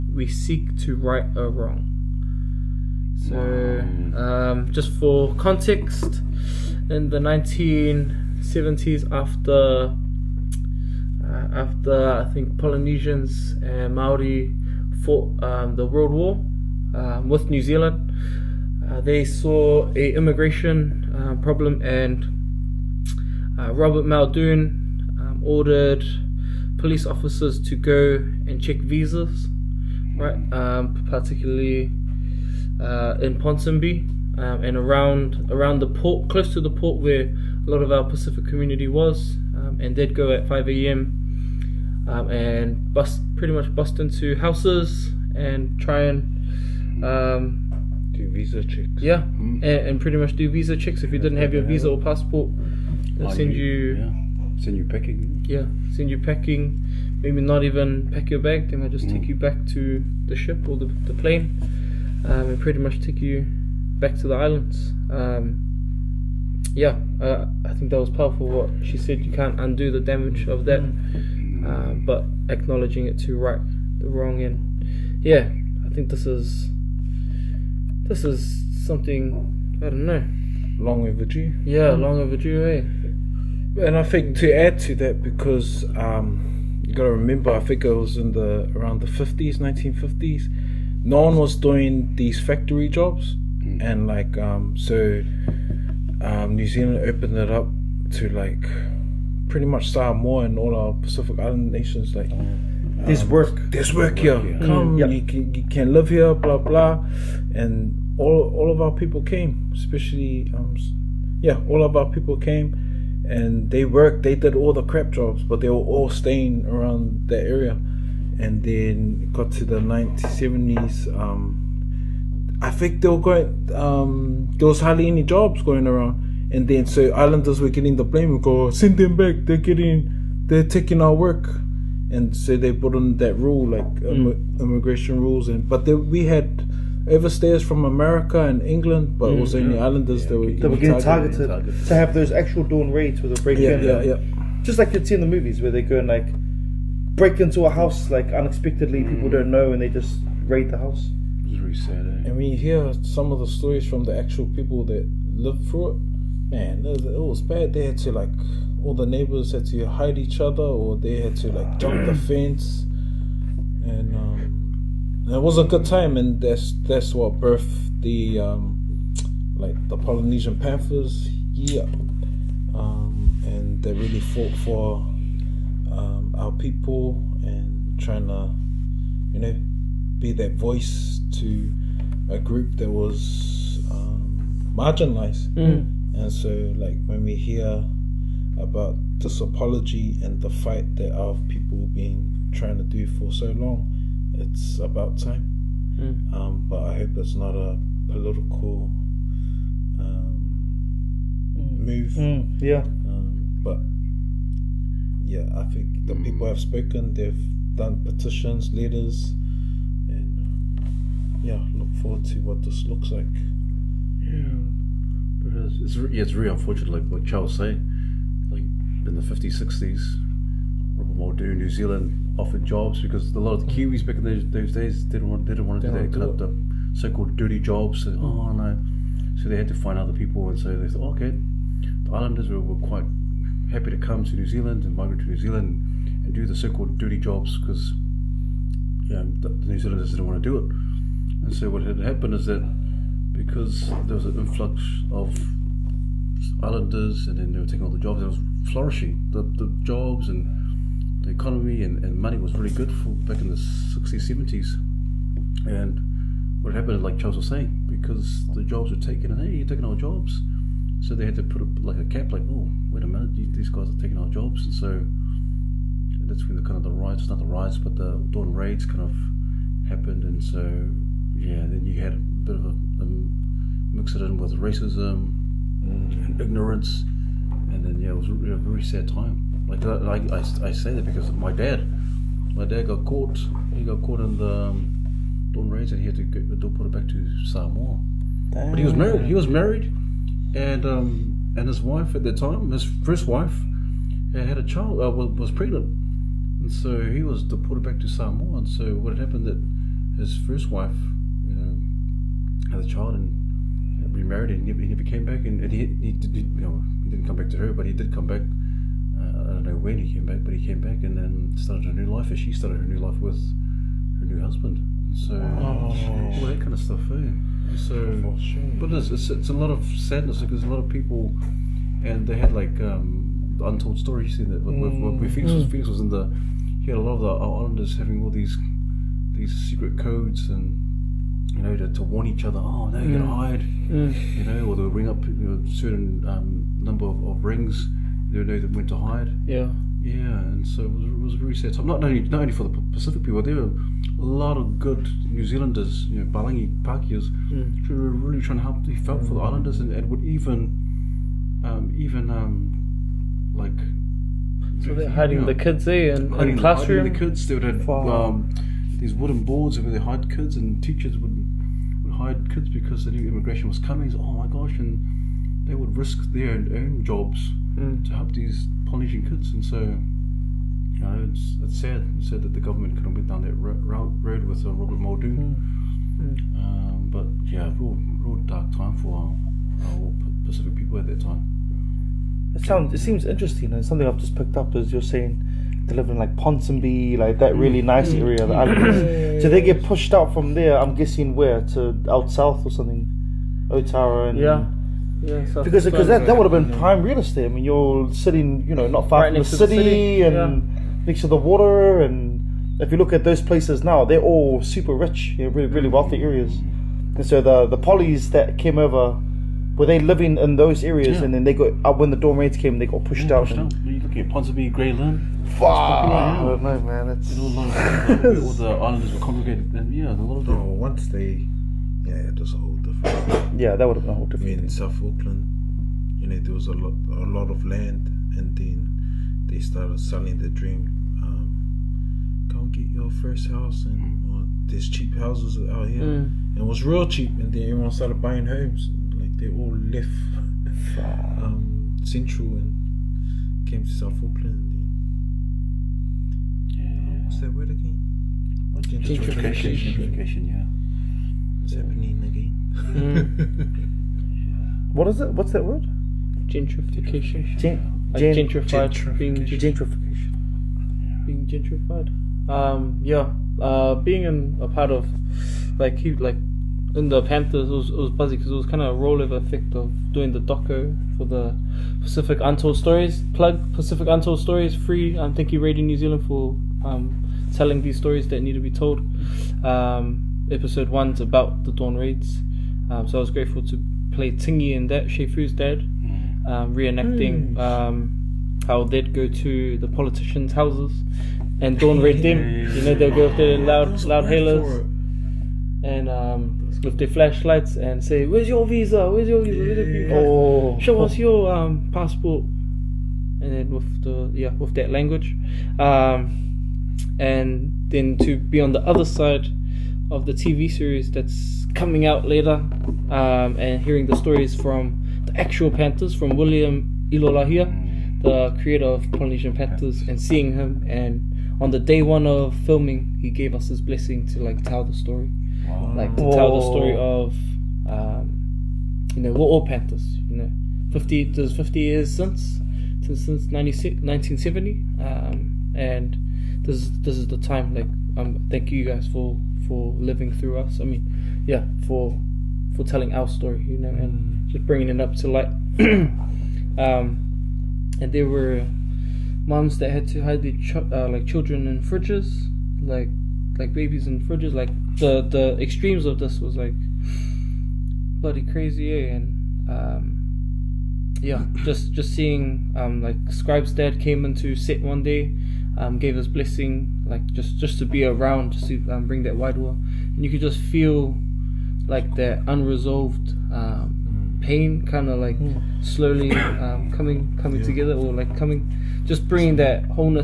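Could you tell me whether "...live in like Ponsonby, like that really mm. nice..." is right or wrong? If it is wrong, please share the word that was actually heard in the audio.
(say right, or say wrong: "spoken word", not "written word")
right.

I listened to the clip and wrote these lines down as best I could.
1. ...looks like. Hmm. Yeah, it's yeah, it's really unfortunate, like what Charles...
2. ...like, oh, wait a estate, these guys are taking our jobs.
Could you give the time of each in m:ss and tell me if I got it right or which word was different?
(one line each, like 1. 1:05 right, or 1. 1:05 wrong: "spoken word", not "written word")
1. 3:32 right
2. 4:22 wrong: "minute", not "estate".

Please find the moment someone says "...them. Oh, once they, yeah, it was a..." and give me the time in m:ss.
7:00.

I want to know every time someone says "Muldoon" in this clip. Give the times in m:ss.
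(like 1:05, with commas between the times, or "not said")
0:24, 3:41, 6:14.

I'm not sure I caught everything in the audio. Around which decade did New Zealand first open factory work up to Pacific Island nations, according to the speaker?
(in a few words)
1950s.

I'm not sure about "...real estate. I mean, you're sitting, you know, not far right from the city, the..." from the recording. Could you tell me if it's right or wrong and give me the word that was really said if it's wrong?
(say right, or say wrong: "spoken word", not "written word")
right.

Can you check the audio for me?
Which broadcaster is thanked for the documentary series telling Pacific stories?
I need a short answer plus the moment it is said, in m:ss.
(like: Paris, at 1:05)
Radio New Zealand, at 7:55.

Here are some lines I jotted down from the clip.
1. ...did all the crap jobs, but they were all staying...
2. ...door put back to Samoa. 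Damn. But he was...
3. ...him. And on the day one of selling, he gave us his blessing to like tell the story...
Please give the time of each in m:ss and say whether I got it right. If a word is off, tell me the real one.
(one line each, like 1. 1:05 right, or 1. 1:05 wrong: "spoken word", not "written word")
1. 1:54 right
2. 4:46 right
3. 8:40 wrong: "filming", not "selling".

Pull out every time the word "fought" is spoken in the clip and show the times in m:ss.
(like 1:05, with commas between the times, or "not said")
0:14, 2:54.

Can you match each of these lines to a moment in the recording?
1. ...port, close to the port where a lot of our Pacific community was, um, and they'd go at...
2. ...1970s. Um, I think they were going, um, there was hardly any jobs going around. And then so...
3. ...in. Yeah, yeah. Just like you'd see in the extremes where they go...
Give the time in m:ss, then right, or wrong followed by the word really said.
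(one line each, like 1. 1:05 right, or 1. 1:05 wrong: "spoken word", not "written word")
1. 0:35 right
2. 1:59 right
3. 2:23 wrong: "movies", not "extremes".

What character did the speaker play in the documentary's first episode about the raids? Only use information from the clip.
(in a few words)
Tingy.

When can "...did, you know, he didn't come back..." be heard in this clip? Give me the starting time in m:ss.
5:06.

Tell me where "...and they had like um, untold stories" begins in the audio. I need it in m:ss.
5:22.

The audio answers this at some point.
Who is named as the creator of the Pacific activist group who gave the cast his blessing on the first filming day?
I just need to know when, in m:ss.
8:36.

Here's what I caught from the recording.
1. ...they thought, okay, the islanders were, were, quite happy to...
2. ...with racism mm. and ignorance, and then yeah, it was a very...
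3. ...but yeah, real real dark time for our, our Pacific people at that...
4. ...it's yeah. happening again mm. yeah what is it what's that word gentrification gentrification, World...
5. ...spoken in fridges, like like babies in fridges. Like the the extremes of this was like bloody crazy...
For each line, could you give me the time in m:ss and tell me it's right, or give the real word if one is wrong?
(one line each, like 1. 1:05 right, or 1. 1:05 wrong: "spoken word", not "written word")
1. 3:50 right
2. 4:34 right
3. 6:17 right
4. 7:31 wrong: "Gen", not "World"
5. 9:11 wrong: "children", not "spoken".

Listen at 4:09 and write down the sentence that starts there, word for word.
The the jobs and the economy and, and money was really good for back in the 60s, 70s.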